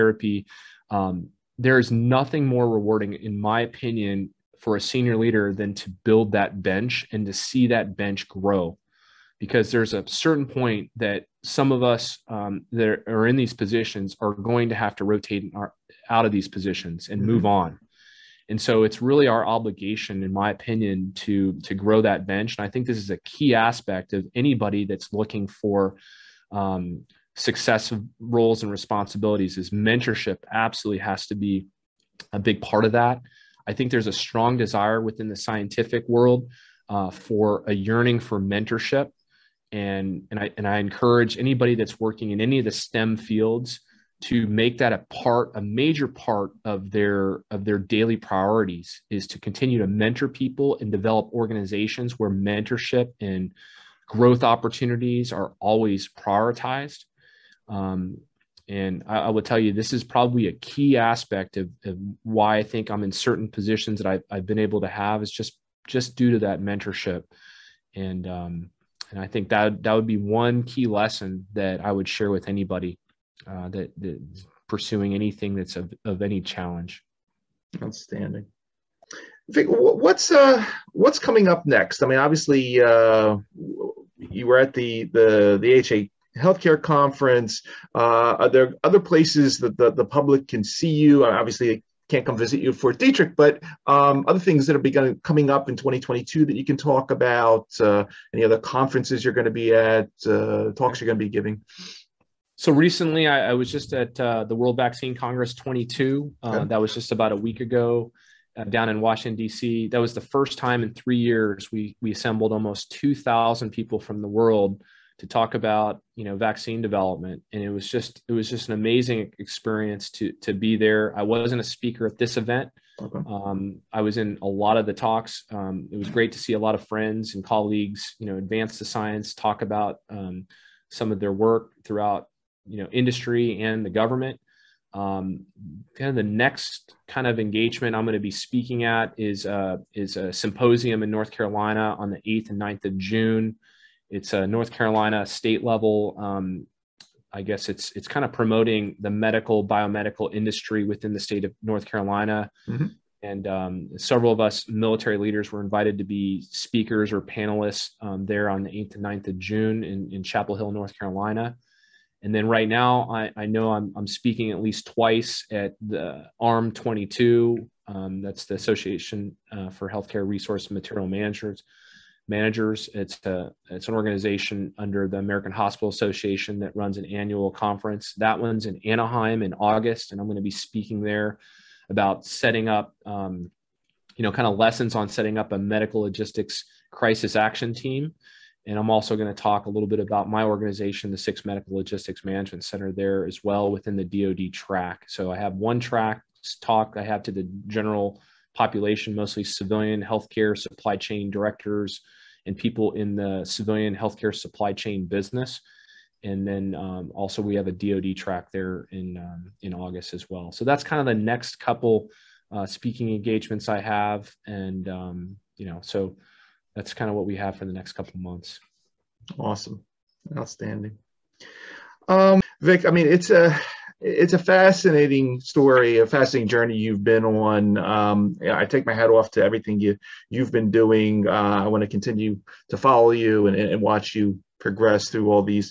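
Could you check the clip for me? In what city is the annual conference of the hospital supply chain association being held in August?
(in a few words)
Anaheim.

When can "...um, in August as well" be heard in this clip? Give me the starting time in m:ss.
3:29.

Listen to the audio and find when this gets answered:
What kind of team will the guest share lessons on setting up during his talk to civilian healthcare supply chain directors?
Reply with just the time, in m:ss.
3:05.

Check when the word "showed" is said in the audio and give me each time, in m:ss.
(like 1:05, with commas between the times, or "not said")
not said.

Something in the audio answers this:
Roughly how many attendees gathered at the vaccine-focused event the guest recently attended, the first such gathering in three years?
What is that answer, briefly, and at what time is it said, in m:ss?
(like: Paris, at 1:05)
2,000, at 1:52.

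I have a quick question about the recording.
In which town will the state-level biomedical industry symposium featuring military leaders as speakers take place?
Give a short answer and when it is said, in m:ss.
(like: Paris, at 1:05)
Chapel Hill, at 2:40.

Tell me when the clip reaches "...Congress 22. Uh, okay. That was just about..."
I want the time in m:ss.
1:45.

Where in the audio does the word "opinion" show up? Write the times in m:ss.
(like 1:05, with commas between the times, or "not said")
0:03, 0:20.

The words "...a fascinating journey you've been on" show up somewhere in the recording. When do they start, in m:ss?
3:45.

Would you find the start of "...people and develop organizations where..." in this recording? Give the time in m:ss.
0:50.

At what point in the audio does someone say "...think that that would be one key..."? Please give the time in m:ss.
1:09.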